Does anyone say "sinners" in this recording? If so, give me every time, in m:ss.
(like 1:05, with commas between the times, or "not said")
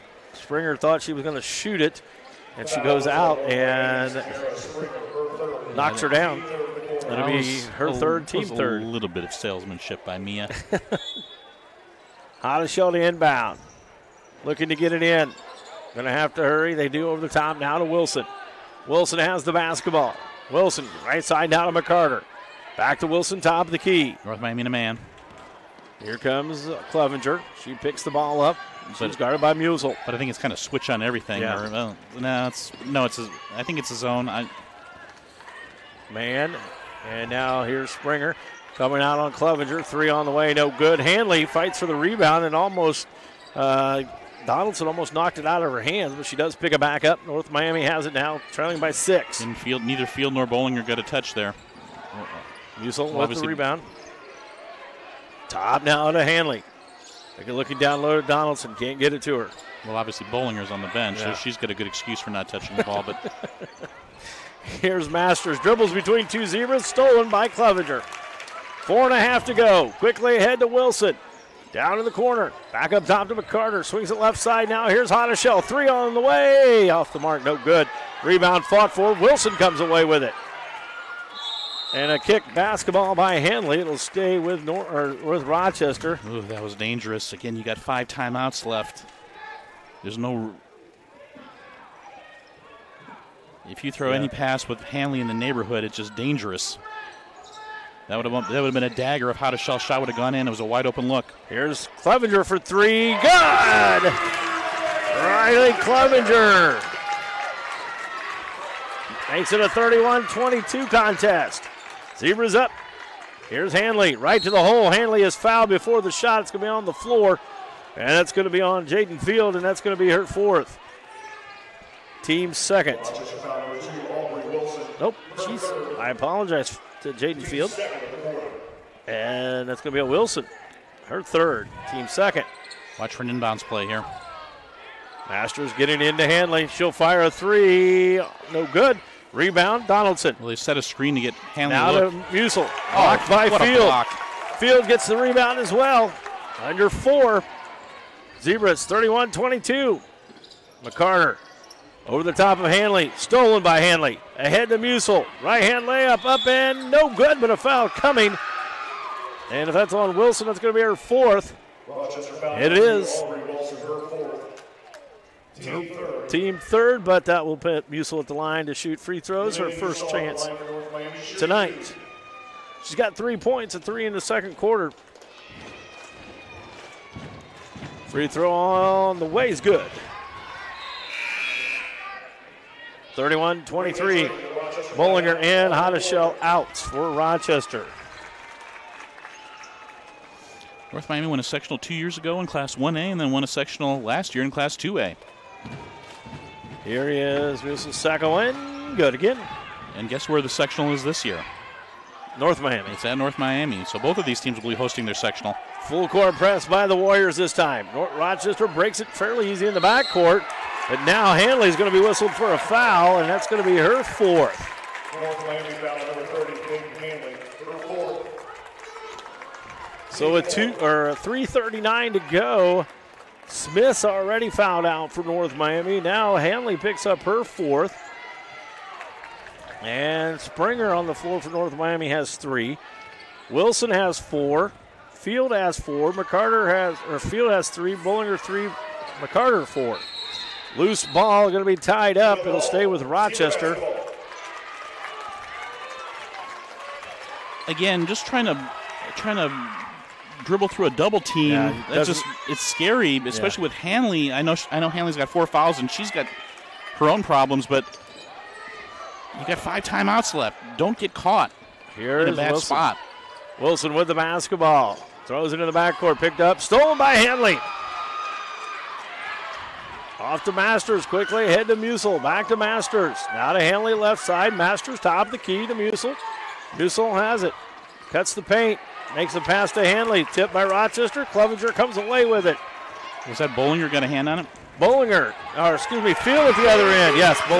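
not said.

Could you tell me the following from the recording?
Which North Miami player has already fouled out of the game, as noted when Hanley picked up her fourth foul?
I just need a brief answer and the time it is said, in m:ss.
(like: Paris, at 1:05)
Smith, at 3:43.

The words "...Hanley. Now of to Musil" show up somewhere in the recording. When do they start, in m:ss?
2:21.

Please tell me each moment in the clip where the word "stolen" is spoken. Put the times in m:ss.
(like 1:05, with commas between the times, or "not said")
1:06, 2:33, 4:26.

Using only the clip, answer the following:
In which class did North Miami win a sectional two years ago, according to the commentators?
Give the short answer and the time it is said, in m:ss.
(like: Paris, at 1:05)
Class 1A, at 3:12.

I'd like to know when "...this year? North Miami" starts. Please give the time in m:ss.
3:21.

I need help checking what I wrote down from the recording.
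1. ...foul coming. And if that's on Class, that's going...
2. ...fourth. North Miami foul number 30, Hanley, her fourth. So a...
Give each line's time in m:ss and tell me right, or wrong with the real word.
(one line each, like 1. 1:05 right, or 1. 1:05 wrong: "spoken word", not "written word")
1. 2:37 wrong: "Wilson", not "Class"
2. 3:34 right.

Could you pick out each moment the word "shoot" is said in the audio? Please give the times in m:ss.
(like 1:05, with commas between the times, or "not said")
0:01, 2:48.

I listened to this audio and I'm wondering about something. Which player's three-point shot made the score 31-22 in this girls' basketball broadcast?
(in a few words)
Riley Clevenger.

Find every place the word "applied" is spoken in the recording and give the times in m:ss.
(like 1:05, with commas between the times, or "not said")
not said.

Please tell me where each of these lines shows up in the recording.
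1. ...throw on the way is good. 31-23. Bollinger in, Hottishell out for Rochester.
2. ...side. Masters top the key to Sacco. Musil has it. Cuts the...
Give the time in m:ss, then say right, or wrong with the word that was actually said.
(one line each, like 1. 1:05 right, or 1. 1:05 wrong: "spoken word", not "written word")
1. 2:58 right
2. 4:34 wrong: "Musil", not "Sacco".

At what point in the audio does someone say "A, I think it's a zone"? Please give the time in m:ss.
0:33.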